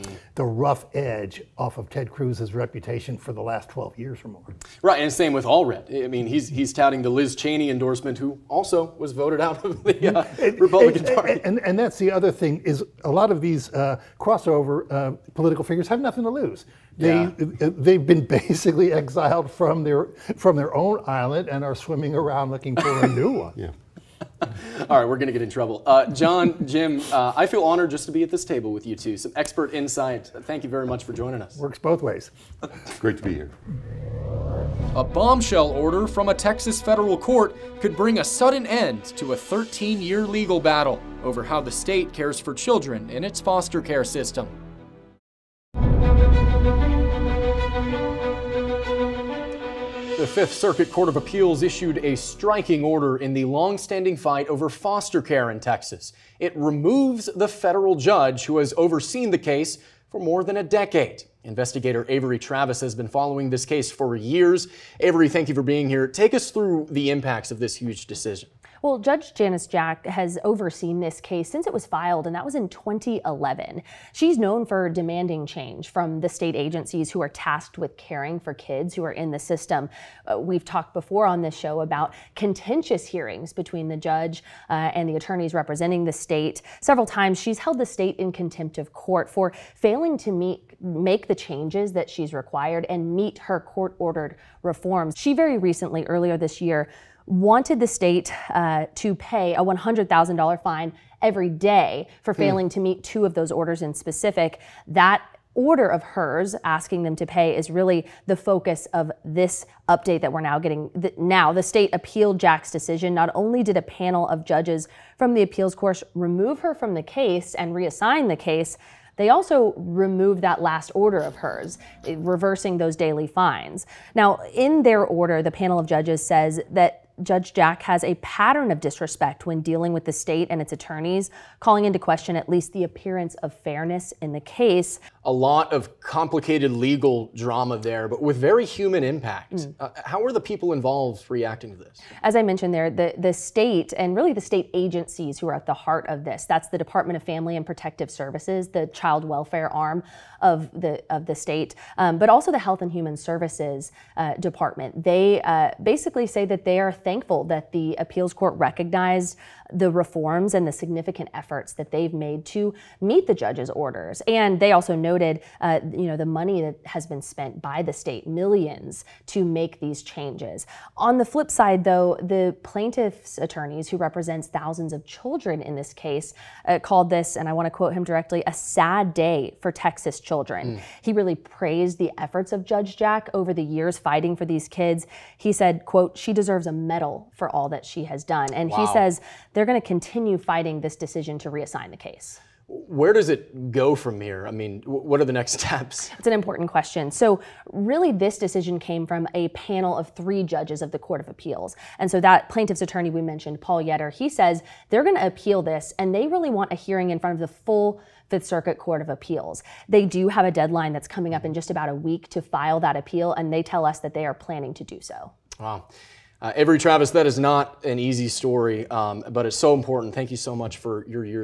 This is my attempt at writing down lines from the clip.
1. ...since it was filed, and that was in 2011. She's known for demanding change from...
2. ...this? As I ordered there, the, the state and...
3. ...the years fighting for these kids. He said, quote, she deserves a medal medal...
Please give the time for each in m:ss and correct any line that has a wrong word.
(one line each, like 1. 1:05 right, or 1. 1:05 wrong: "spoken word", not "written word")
1. 1:11 right
2. 2:21 wrong: "mentioned", not "ordered"
3. 3:03 right.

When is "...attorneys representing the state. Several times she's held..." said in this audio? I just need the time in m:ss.
1:25.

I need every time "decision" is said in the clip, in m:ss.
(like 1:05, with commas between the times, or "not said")
1:08, 1:52, 3:10, 3:18.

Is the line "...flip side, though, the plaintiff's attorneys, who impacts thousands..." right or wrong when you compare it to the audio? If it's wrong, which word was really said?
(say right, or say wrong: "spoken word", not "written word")
wrong: "represents", not "impacts".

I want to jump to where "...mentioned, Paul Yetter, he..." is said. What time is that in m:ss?
3:23.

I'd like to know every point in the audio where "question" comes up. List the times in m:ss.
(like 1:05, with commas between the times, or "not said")
2:11, 3:16.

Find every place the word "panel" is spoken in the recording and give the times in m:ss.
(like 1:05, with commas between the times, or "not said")
1:53, 2:05, 3:19.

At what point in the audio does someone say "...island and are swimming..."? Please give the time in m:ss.
0:21.